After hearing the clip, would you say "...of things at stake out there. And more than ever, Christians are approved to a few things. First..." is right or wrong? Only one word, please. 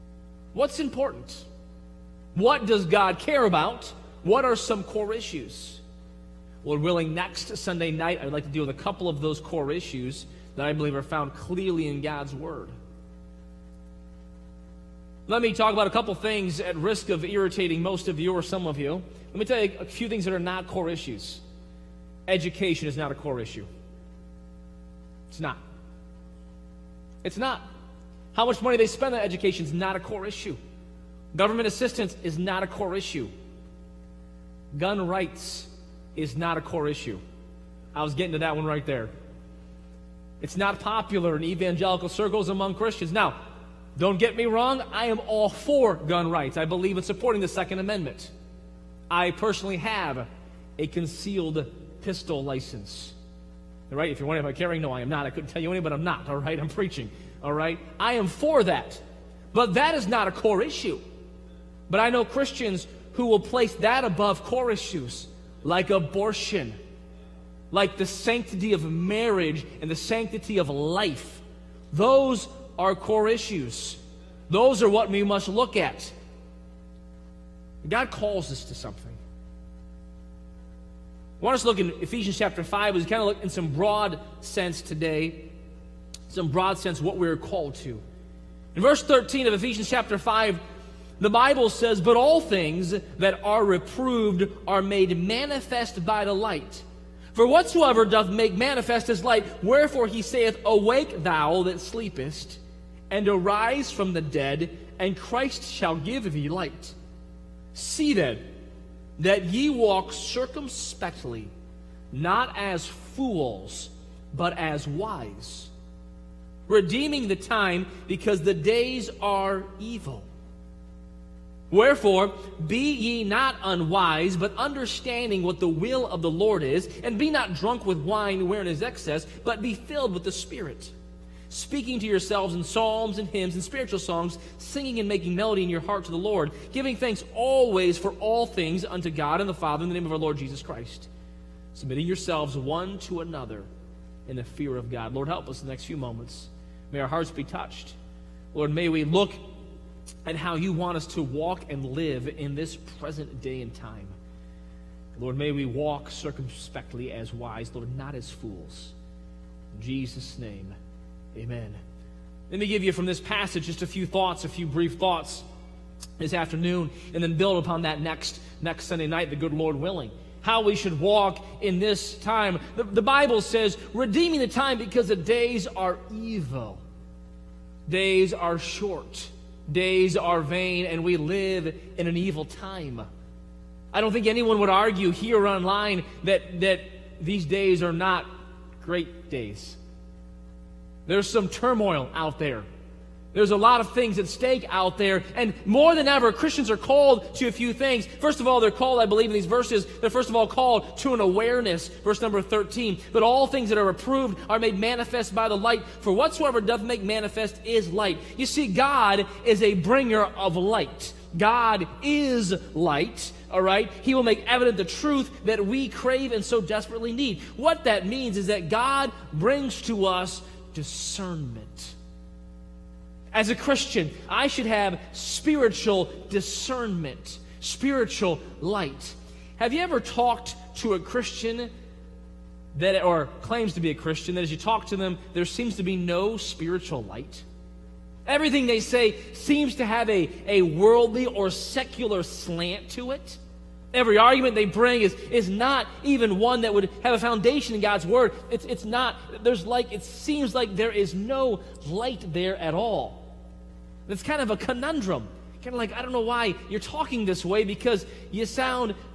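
wrong.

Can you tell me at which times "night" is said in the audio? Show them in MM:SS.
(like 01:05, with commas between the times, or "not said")
00:07, 02:49.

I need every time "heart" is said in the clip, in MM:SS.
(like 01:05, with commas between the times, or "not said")
02:15, 02:27.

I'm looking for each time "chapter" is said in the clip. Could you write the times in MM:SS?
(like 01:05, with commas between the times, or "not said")
01:22, 01:29.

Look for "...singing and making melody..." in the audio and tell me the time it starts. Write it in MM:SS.
02:14.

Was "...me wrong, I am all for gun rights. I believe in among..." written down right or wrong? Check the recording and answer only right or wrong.
wrong.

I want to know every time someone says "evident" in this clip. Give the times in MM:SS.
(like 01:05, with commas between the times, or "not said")
03:34.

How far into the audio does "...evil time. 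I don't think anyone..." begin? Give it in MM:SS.
03:02.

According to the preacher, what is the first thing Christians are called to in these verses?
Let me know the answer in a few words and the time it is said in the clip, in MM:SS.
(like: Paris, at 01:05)
an awareness, at 03:21.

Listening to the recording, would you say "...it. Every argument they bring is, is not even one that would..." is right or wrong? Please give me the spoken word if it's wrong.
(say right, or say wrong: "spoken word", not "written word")
right.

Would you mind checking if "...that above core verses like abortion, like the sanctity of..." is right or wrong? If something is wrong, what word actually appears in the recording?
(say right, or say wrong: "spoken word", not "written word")
wrong: "issues", not "verses".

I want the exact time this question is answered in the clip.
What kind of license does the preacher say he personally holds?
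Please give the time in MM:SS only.
00:50.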